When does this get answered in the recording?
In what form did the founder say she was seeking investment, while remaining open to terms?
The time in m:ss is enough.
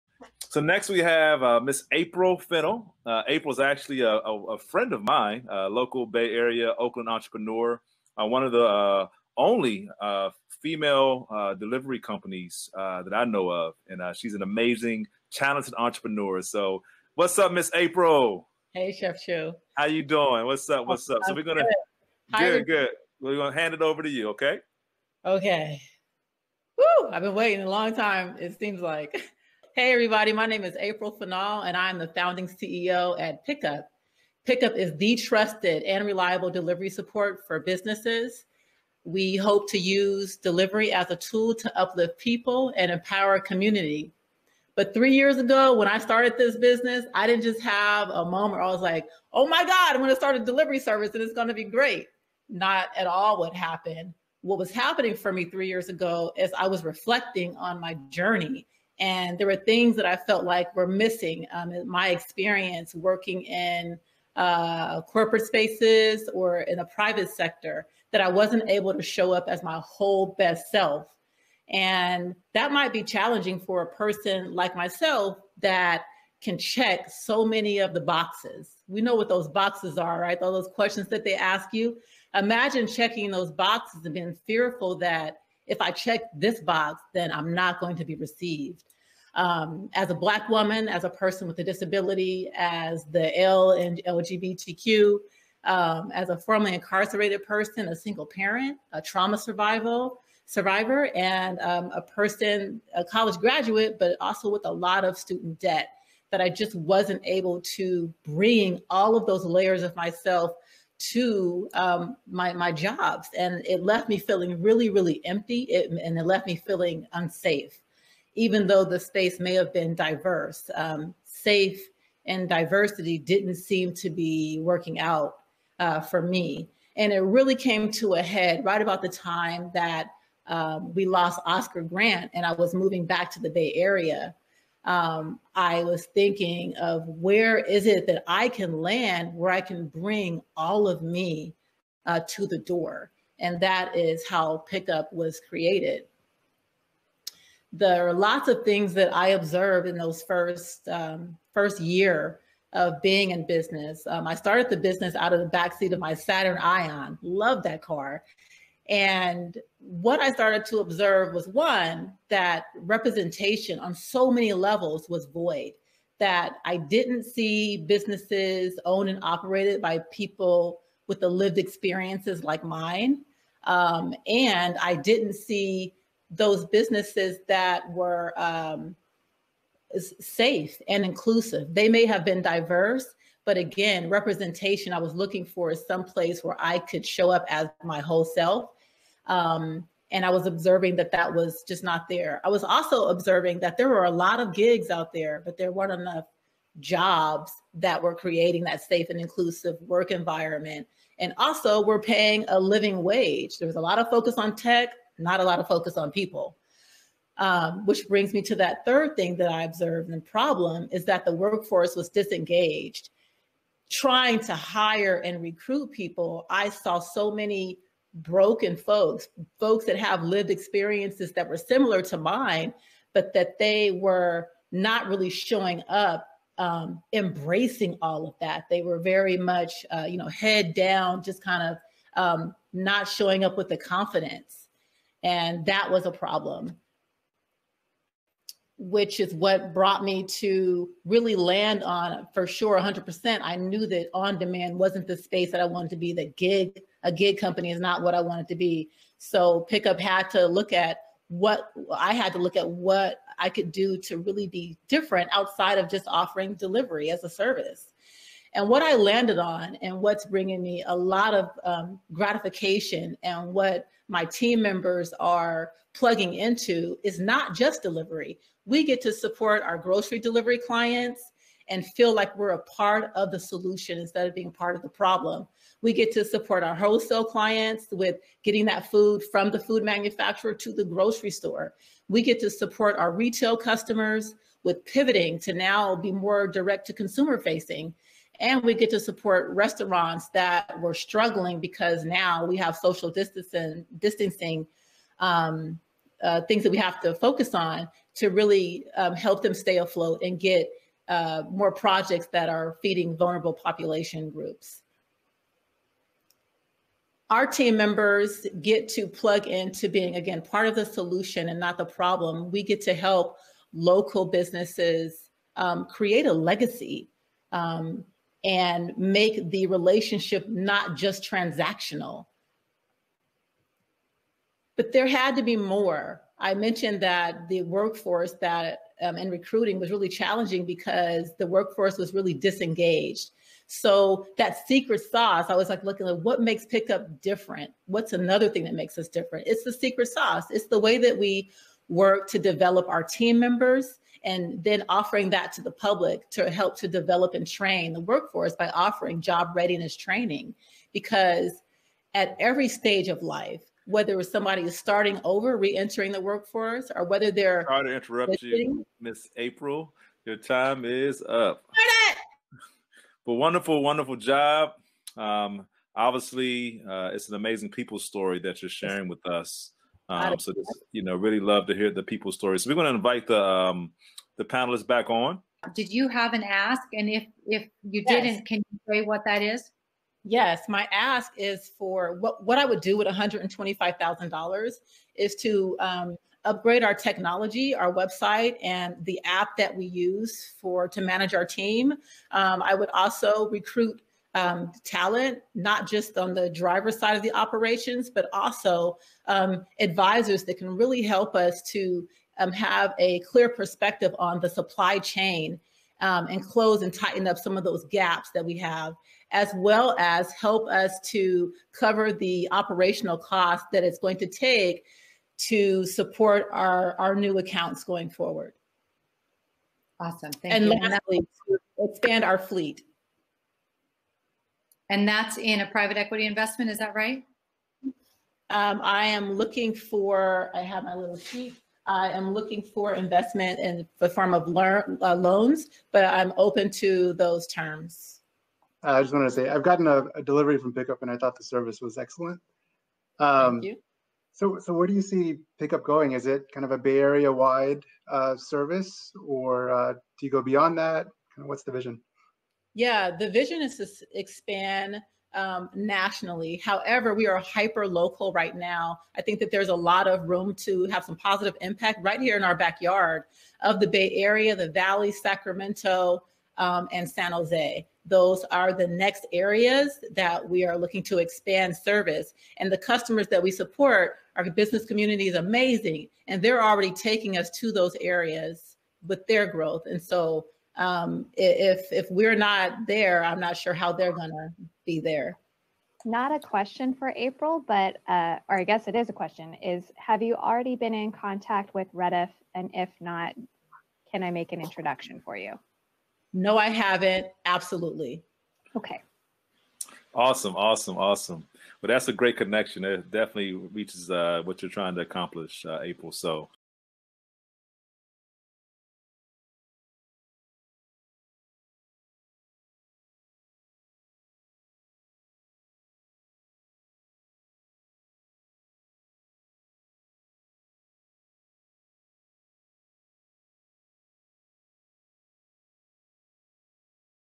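7:15.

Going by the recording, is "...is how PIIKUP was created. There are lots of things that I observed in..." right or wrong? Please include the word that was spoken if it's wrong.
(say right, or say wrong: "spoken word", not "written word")
right.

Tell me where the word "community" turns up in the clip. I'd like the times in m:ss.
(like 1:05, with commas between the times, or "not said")
0:43, 7:54.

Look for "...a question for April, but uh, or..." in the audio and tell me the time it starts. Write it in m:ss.
8:06.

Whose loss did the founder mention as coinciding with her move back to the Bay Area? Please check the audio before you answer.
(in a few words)
Oscar Grant.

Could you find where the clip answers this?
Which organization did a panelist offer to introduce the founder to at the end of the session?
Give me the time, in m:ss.
8:11.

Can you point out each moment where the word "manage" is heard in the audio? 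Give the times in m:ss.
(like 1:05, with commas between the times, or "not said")
6:30.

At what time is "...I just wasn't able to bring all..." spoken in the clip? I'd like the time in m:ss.
1:46.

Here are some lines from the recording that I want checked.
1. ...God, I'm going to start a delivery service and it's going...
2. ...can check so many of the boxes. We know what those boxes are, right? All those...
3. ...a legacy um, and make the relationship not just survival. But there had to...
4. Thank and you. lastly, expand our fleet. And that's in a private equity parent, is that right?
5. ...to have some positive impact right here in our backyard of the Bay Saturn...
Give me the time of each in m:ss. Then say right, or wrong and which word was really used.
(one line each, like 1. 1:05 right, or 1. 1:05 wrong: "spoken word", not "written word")
1. 0:49 right
2. 1:16 right
3. 5:16 wrong: "transactional", not "survival"
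4. 7:00 wrong: "investment", not "parent"
5. 7:40 wrong: "Area", not "Saturn".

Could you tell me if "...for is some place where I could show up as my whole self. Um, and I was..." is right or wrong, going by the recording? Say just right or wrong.
right.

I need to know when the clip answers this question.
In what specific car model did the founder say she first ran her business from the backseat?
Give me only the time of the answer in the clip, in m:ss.
2:36.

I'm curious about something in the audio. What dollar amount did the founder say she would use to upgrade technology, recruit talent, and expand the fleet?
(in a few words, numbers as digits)
$125,000.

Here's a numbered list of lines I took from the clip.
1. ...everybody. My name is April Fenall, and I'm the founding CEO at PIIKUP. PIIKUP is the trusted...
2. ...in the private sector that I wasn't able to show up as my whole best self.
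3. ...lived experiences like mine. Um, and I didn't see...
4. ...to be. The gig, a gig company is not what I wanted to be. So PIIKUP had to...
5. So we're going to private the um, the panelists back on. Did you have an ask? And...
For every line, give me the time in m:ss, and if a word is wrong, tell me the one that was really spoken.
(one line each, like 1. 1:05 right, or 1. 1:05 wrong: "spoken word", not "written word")
1. 0:29 right
2. 1:06 right
3. 2:51 right
4. 4:05 right
5. 6:12 wrong: "invite", not "private".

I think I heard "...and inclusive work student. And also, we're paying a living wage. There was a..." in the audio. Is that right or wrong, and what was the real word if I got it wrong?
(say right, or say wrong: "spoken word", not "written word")
wrong: "environment", not "student".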